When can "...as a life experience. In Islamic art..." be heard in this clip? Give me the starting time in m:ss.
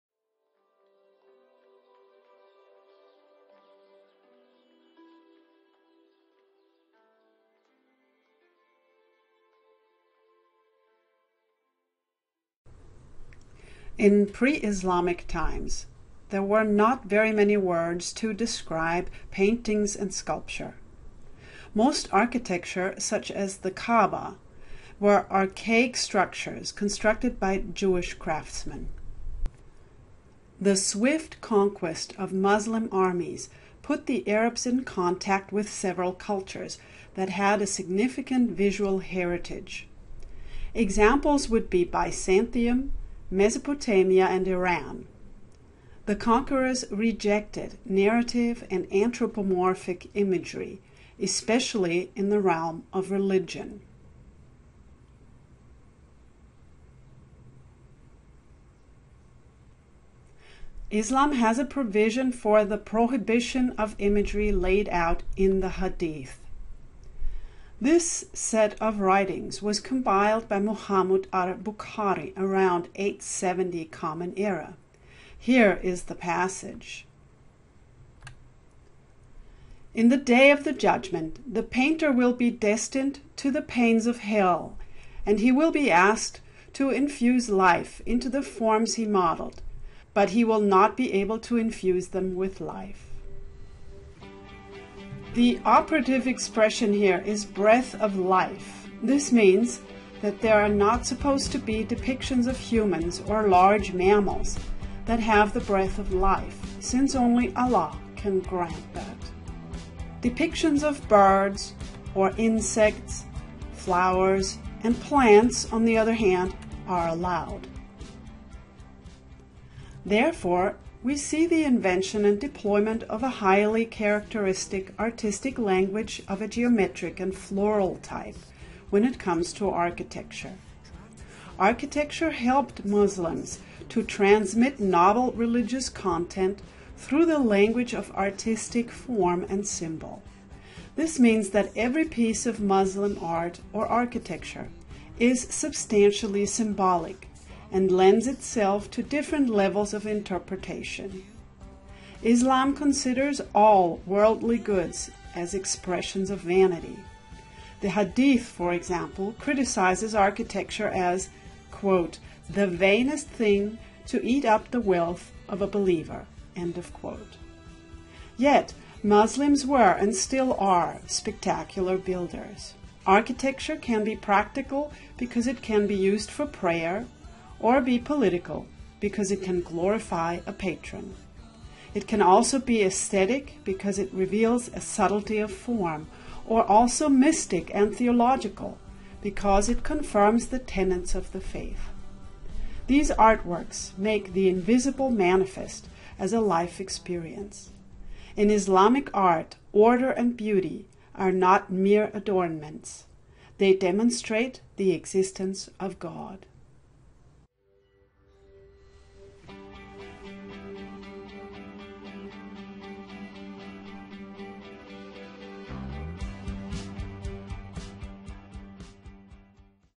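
3:16.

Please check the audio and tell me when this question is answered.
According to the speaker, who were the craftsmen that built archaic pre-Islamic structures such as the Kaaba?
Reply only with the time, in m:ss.
0:27.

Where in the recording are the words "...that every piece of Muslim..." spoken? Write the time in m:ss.
2:21.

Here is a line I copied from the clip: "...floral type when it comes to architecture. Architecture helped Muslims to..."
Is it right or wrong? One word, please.
right.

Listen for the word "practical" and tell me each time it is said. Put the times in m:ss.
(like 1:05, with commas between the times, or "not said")
2:54.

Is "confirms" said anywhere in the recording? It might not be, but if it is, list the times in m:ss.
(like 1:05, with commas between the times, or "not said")
3:09.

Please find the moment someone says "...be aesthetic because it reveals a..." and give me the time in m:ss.
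3:02.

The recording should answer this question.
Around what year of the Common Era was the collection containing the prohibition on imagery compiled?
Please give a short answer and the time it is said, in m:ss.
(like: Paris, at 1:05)
870, at 1:12.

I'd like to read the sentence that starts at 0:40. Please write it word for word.
Examples would be Byzantium, Mesopotamia and Iran.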